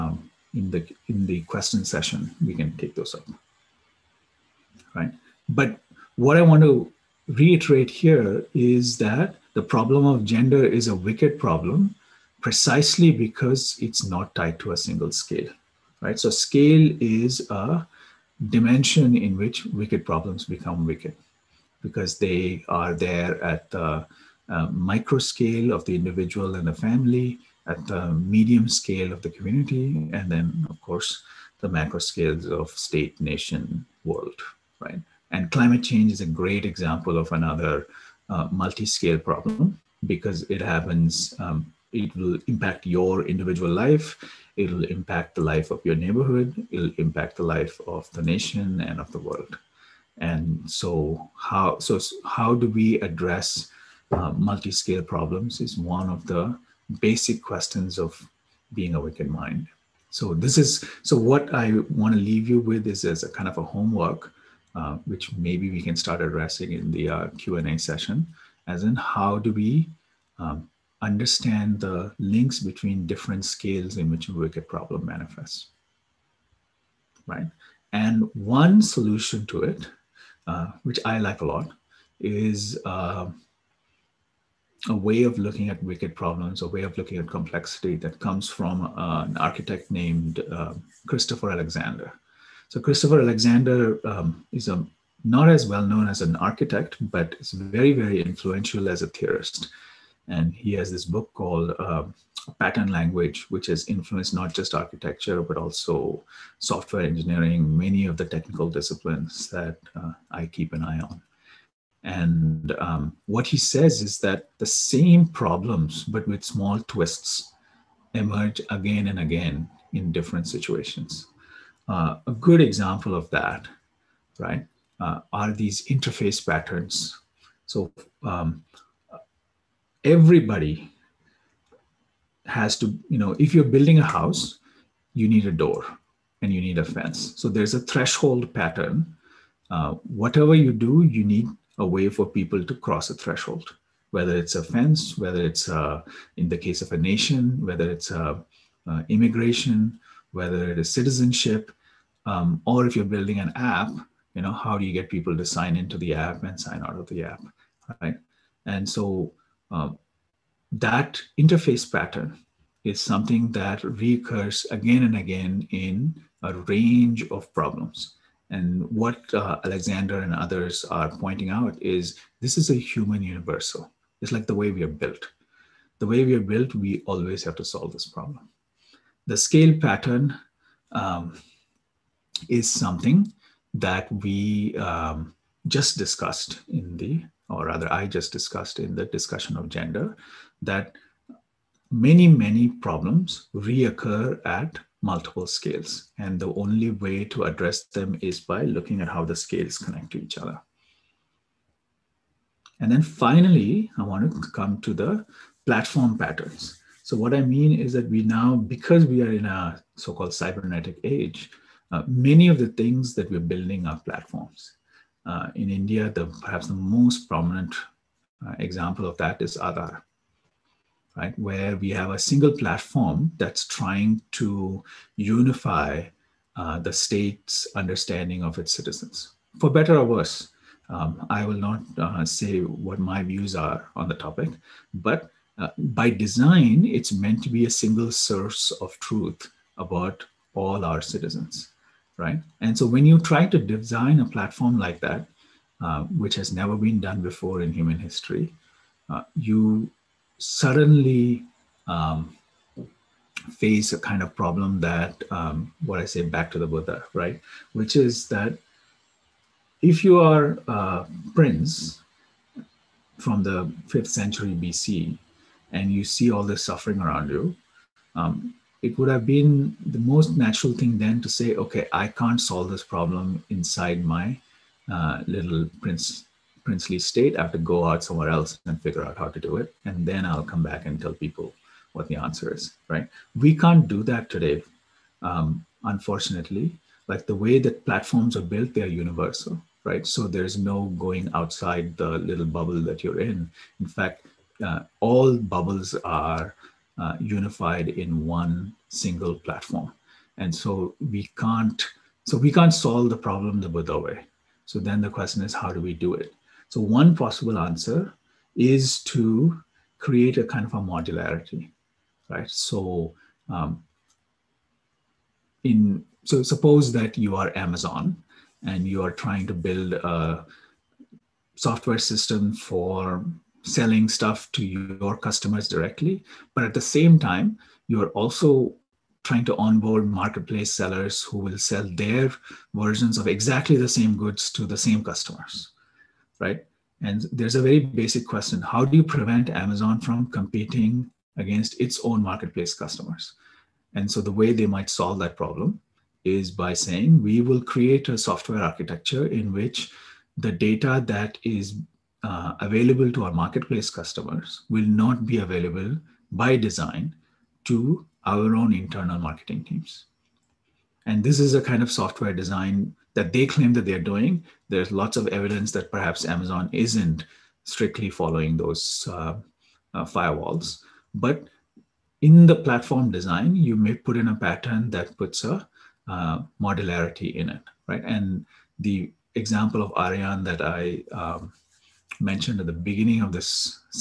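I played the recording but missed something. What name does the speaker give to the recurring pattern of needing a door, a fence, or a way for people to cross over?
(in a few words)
threshold pattern.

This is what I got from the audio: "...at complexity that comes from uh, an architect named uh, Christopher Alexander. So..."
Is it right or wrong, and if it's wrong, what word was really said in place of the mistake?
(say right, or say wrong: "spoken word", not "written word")
right.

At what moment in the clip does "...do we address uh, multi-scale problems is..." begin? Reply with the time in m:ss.
0:52.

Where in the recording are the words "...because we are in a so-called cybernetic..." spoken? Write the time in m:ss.
3:28.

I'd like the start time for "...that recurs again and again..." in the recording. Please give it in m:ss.
2:43.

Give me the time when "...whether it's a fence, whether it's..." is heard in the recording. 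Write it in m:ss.
2:24.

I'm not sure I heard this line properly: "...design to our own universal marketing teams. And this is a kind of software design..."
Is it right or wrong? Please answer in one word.
wrong.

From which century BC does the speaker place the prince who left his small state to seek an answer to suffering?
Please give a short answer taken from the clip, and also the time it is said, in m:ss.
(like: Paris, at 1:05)
fifth century BC, at 4:23.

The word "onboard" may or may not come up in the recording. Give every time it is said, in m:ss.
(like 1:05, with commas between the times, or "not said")
5:29.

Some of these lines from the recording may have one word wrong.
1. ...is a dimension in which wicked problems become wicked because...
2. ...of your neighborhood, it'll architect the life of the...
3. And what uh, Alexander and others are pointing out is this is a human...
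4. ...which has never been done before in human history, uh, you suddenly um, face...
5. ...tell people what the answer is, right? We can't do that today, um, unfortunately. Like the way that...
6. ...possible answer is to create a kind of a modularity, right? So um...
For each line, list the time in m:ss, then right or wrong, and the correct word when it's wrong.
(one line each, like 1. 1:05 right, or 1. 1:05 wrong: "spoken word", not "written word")
1. 0:16 right
2. 0:45 wrong: "impact", not "architect"
3. 2:48 right
4. 4:06 right
5. 4:40 right
6. 5:07 right.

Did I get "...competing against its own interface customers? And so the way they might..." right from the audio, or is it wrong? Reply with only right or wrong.
wrong.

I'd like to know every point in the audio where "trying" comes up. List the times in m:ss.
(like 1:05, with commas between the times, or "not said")
3:43, 5:19, 5:29.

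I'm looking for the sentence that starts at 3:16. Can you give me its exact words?
And the only way to address them is by looking at how the scales connect to each other.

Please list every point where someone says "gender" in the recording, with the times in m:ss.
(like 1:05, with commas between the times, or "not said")
0:10, 3:09.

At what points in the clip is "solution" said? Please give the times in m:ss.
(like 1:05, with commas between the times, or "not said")
1:18.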